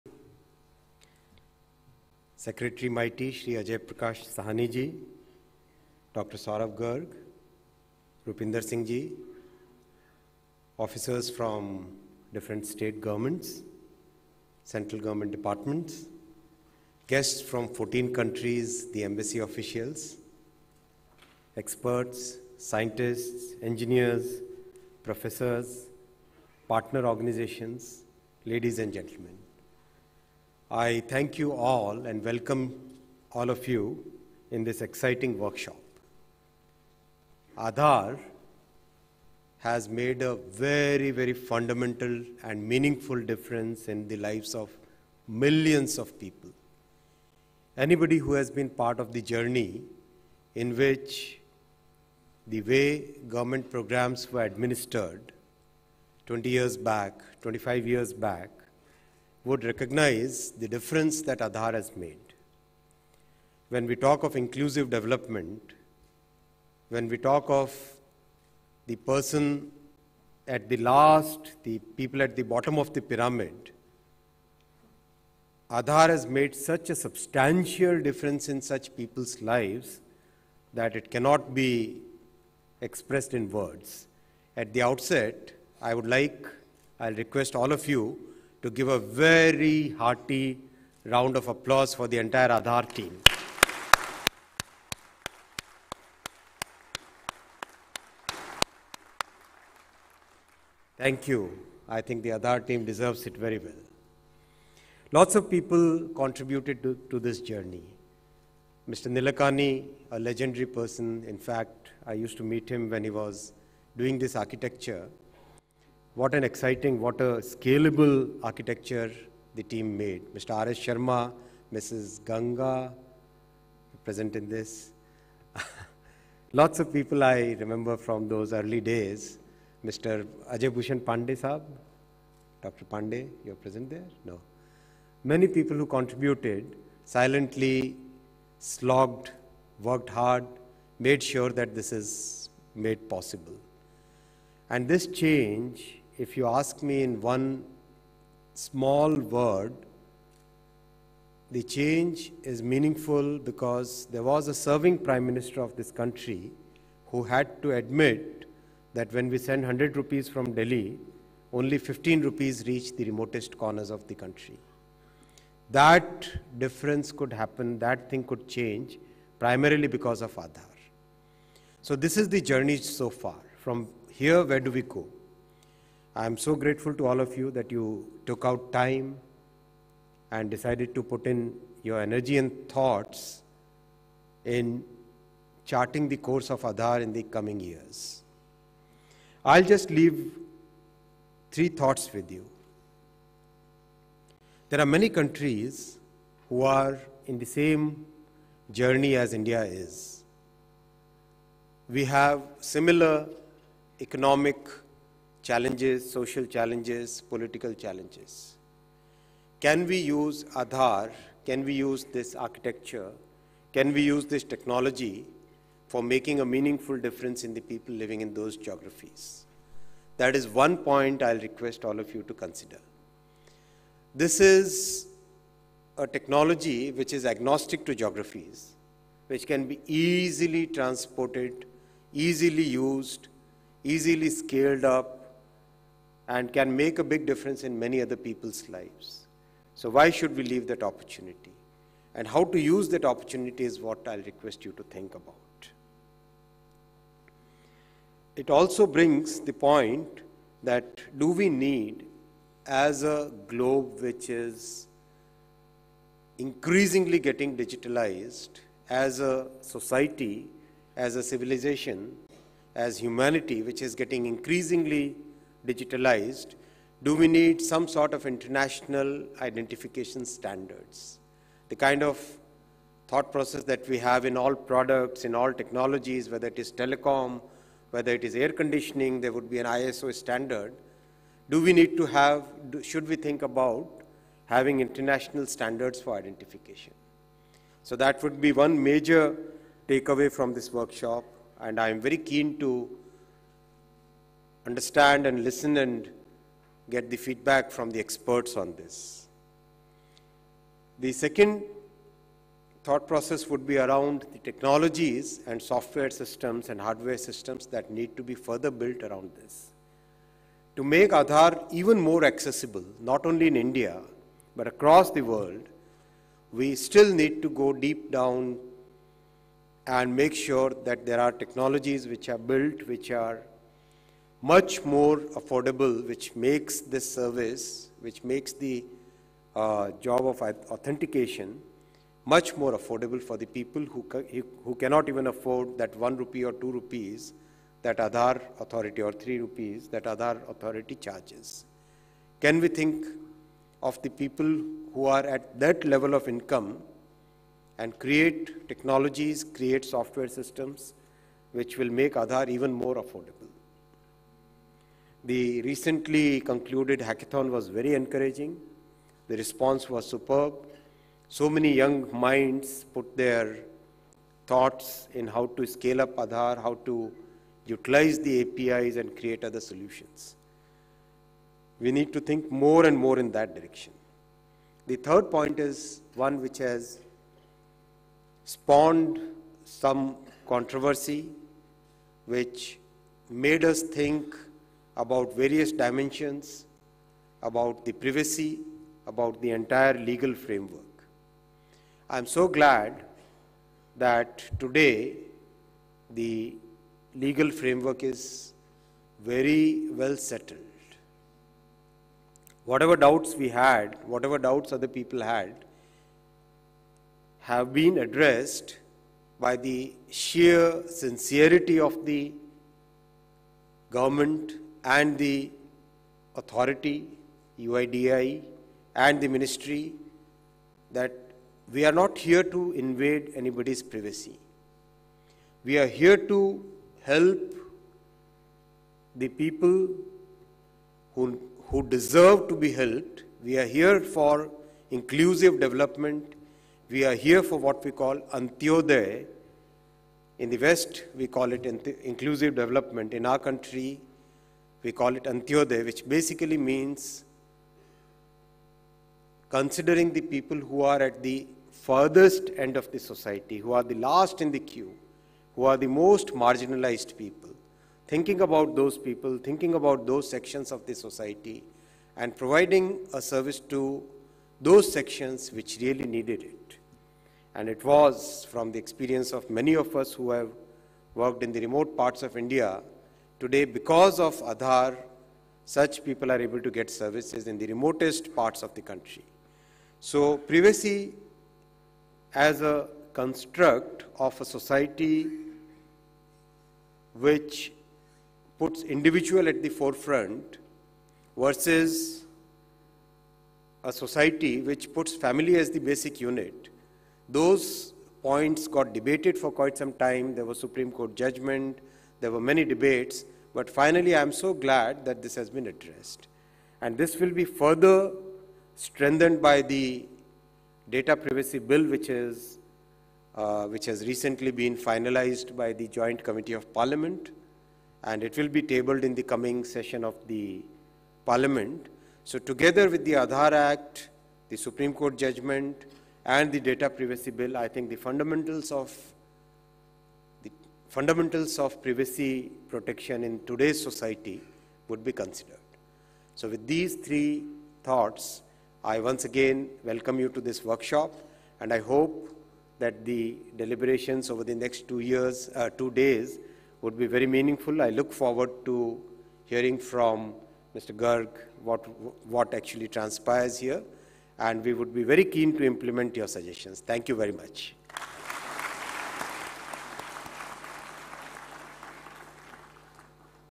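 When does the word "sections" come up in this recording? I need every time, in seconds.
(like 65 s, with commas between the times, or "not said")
460 s, 464 s.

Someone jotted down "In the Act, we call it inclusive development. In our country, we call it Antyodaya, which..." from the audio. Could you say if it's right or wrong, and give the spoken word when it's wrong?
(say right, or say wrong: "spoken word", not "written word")
wrong: "West", not "Act".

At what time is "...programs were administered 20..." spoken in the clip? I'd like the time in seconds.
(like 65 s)
53 s.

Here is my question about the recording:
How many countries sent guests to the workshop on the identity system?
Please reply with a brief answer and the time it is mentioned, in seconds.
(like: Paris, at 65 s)
14, at 17 s.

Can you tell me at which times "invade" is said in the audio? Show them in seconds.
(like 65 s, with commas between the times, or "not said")
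422 s.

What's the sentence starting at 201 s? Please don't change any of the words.
We have similar economic challenges, social challenges, political challenges.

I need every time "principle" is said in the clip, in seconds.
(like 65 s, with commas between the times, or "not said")
not said.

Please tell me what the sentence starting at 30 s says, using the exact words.
I thank you all and welcome all of you in this exciting workshop.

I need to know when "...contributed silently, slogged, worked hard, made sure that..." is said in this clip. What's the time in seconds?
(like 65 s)
135 s.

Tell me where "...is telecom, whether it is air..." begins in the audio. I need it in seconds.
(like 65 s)
276 s.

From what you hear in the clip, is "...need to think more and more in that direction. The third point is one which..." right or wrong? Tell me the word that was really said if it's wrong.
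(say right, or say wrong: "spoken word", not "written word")
right.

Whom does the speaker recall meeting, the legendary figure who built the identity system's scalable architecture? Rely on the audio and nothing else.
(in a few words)
Mr. Nilekani.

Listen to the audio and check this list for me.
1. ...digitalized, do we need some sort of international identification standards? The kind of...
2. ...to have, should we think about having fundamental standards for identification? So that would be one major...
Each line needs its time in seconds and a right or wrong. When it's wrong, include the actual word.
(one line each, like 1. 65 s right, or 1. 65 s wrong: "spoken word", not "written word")
1. 265 s right
2. 281 s wrong: "international", not "fundamental".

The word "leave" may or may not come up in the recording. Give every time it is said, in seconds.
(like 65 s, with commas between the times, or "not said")
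189 s, 240 s.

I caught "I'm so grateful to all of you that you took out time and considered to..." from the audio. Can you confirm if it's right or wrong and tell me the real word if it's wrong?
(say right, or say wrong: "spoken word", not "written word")
wrong: "decided", not "considered".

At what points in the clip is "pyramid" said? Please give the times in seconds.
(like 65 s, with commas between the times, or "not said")
73 s.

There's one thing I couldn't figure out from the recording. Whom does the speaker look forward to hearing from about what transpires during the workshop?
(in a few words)
Mr. Garg.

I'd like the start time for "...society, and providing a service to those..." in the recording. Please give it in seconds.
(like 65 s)
460 s.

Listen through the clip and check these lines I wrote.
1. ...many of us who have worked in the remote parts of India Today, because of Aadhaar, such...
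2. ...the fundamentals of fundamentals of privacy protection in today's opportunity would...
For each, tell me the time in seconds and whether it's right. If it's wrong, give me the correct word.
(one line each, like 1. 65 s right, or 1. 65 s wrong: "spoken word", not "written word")
1. 469 s right
2. 527 s wrong: "society", not "opportunity".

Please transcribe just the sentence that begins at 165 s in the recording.
That difference could happen, that thing could change, primarily because of Aadhaar.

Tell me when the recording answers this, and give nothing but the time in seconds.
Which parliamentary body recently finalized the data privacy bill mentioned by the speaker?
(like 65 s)
515 s.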